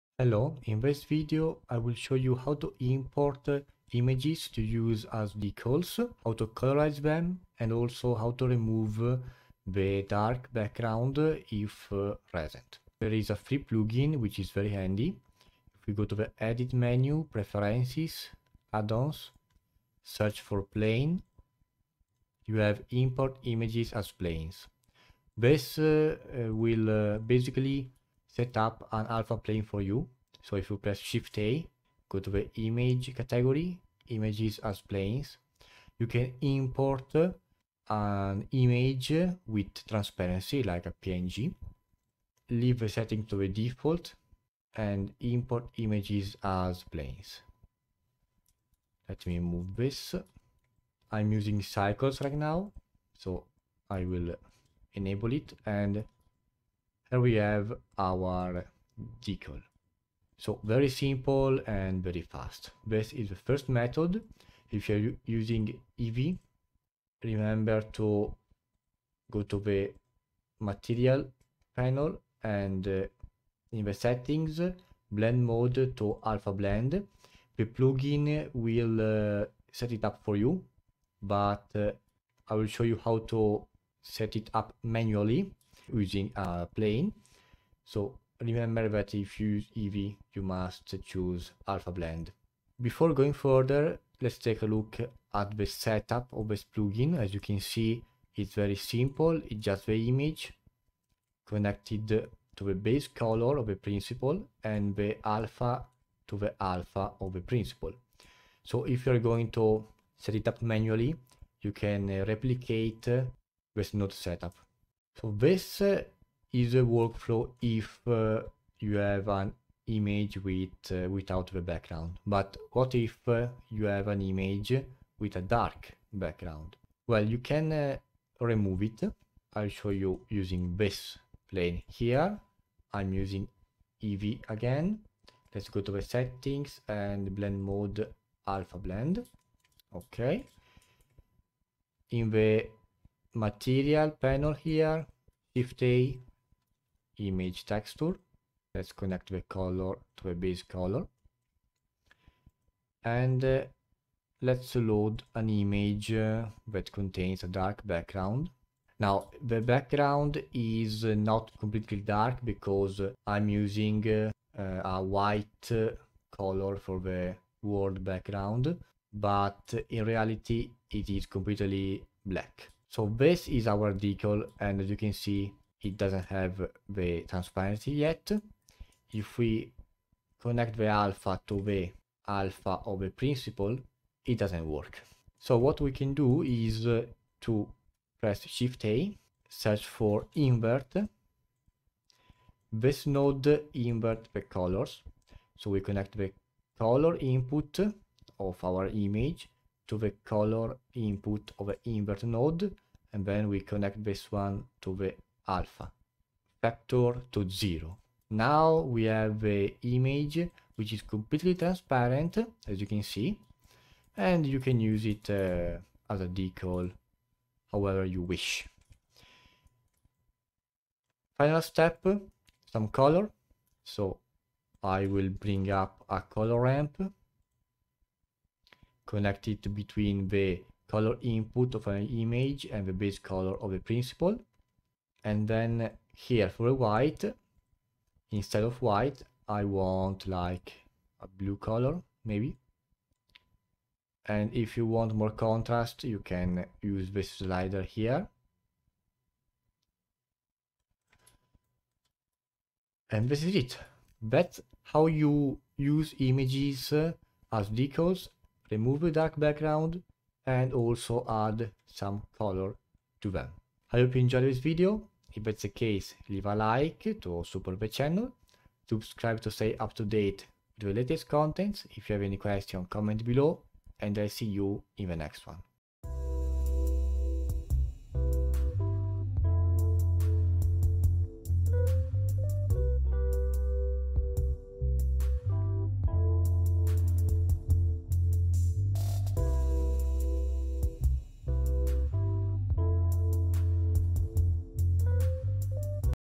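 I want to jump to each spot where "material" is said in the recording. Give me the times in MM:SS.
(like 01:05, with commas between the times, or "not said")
01:10, 02:23.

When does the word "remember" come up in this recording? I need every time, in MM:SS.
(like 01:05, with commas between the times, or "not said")
01:07, 01:28.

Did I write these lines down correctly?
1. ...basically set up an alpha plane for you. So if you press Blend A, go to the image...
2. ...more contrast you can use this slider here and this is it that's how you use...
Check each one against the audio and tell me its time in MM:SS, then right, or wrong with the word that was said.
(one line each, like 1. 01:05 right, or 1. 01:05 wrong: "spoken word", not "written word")
1. 00:27 wrong: "Shift", not "Blend"
2. 04:05 right.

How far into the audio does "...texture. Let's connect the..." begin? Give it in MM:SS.
02:27.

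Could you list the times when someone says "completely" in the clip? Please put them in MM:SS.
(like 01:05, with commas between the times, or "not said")
02:41, 02:51, 03:31.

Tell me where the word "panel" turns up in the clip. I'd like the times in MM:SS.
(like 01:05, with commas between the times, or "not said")
01:11, 02:24.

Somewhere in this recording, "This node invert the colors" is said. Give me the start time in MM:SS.
03:12.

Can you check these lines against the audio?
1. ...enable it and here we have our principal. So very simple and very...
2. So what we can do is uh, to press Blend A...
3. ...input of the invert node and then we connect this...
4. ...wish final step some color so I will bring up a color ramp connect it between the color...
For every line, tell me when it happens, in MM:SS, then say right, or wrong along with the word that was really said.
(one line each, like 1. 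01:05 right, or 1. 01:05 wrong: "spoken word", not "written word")
1. 00:54 wrong: "decal", not "principal"
2. 03:05 wrong: "Shift", not "Blend"
3. 03:20 right
4. 03:38 right.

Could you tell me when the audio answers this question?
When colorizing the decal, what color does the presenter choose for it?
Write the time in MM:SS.
04:01.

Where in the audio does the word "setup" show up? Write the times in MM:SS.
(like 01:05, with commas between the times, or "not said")
01:35, 01:54.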